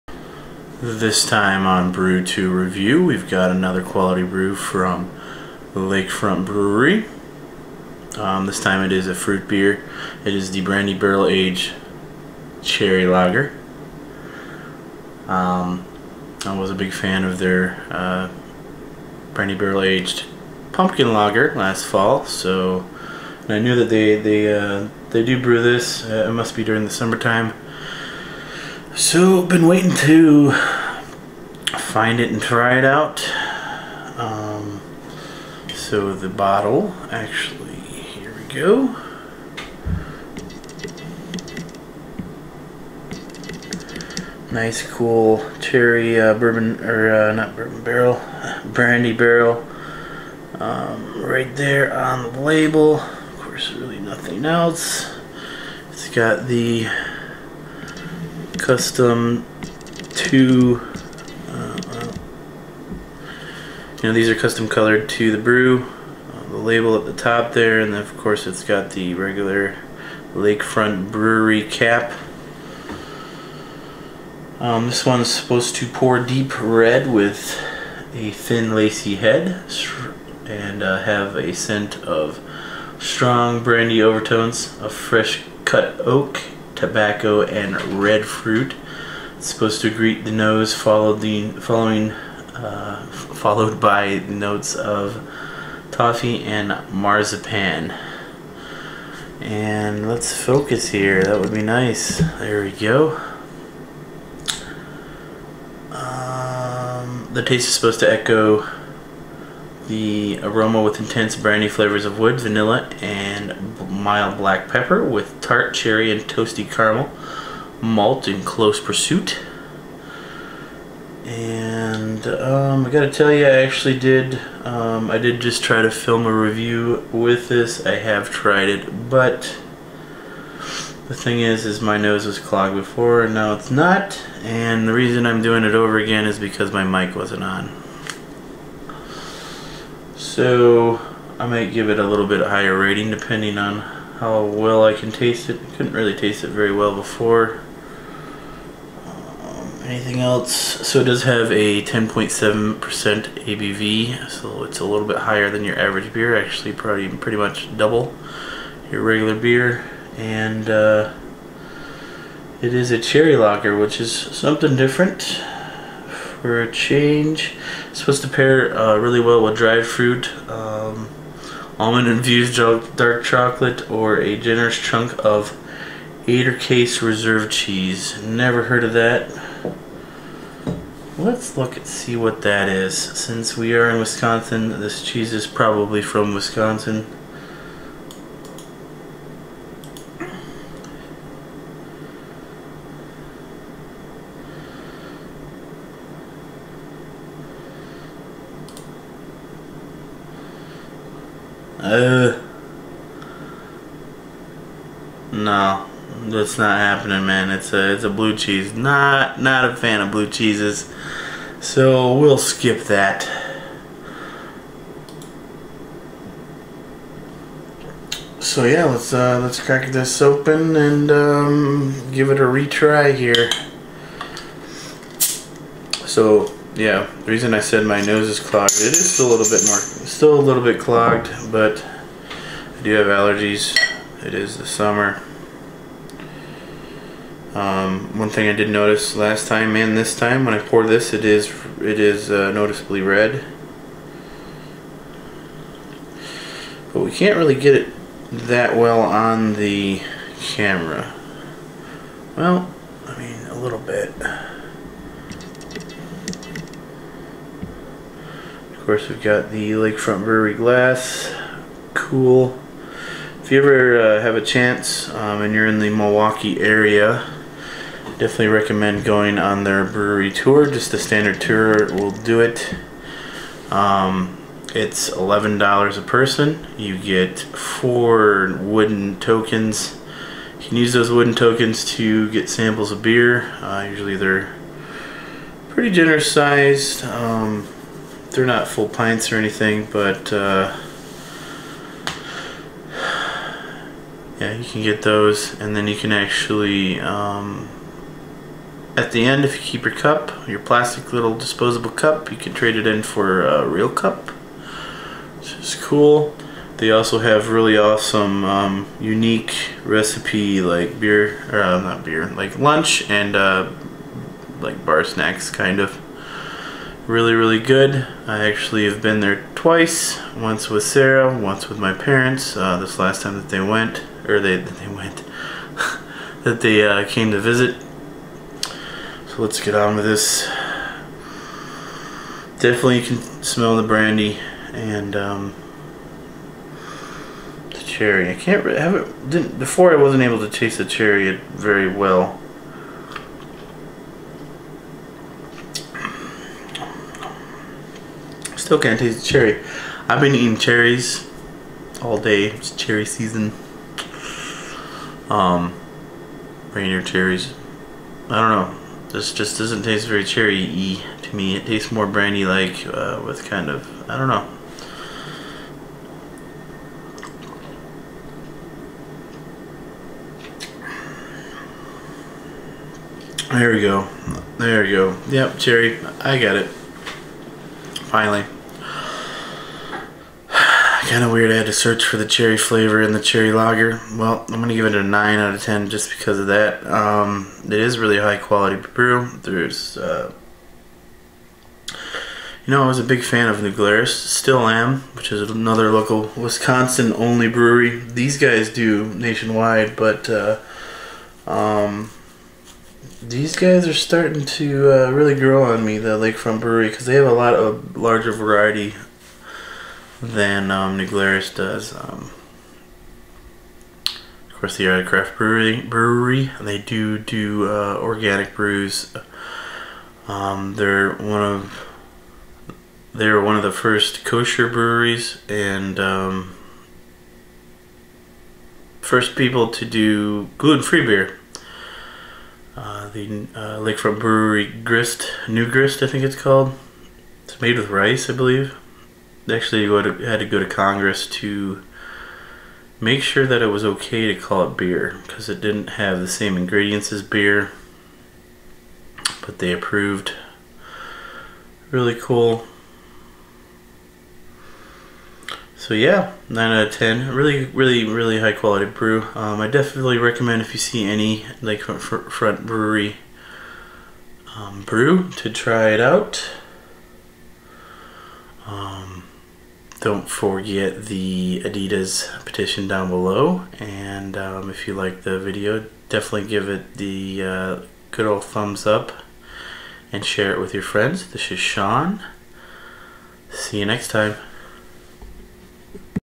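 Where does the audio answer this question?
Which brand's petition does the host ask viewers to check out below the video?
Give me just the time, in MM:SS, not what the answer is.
07:51.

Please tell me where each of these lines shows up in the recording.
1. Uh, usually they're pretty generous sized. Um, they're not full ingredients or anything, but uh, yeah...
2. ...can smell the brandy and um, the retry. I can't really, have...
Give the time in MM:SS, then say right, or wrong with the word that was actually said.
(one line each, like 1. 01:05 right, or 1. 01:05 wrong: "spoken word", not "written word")
1. 04:43 wrong: "pints", not "ingredients"
2. 05:33 wrong: "cherry", not "retry".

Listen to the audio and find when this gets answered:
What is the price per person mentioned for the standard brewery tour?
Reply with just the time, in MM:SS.
04:35.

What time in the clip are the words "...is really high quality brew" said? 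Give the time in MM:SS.
06:27.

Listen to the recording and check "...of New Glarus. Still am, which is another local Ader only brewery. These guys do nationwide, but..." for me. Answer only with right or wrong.
wrong.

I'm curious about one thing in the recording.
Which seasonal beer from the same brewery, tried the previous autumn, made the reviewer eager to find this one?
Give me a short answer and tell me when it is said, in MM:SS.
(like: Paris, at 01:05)
Brandy Barrel Aged Pumpkin Lager, at 00:19.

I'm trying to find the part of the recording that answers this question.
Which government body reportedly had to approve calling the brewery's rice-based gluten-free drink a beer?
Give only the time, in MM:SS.
07:20.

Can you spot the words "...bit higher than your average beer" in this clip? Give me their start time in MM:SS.
02:35.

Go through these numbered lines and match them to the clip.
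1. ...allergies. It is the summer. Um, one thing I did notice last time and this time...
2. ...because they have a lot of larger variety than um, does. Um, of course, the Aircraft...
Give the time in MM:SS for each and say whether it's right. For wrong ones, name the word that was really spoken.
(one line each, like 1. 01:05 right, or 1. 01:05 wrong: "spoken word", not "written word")
1. 03:53 right
2. 06:46 right.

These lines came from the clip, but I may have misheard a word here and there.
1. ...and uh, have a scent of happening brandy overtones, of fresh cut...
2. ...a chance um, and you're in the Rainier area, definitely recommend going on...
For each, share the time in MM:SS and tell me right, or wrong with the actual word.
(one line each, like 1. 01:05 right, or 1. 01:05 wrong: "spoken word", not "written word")
1. 01:20 wrong: "strong", not "happening"
2. 04:24 wrong: "Milwaukee", not "Rainier".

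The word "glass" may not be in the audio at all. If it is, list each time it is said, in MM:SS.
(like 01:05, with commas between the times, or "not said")
04:20.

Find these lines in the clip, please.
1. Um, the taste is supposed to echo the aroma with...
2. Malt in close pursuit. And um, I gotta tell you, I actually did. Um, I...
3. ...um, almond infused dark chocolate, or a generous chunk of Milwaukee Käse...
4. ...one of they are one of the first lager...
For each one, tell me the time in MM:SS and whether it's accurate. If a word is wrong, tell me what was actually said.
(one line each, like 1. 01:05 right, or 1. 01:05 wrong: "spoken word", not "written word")
1. 01:45 right
2. 01:57 right
3. 02:50 wrong: "Ader", not "Milwaukee"
4. 07:01 wrong: "kosher", not "lager".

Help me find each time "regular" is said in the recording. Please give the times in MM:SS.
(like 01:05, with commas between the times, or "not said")
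01:09, 02:39.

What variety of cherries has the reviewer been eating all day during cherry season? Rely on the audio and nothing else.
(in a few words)
Rainier.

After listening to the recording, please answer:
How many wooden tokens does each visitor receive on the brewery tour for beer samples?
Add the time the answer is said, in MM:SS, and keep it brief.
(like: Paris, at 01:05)
4, at 04:37.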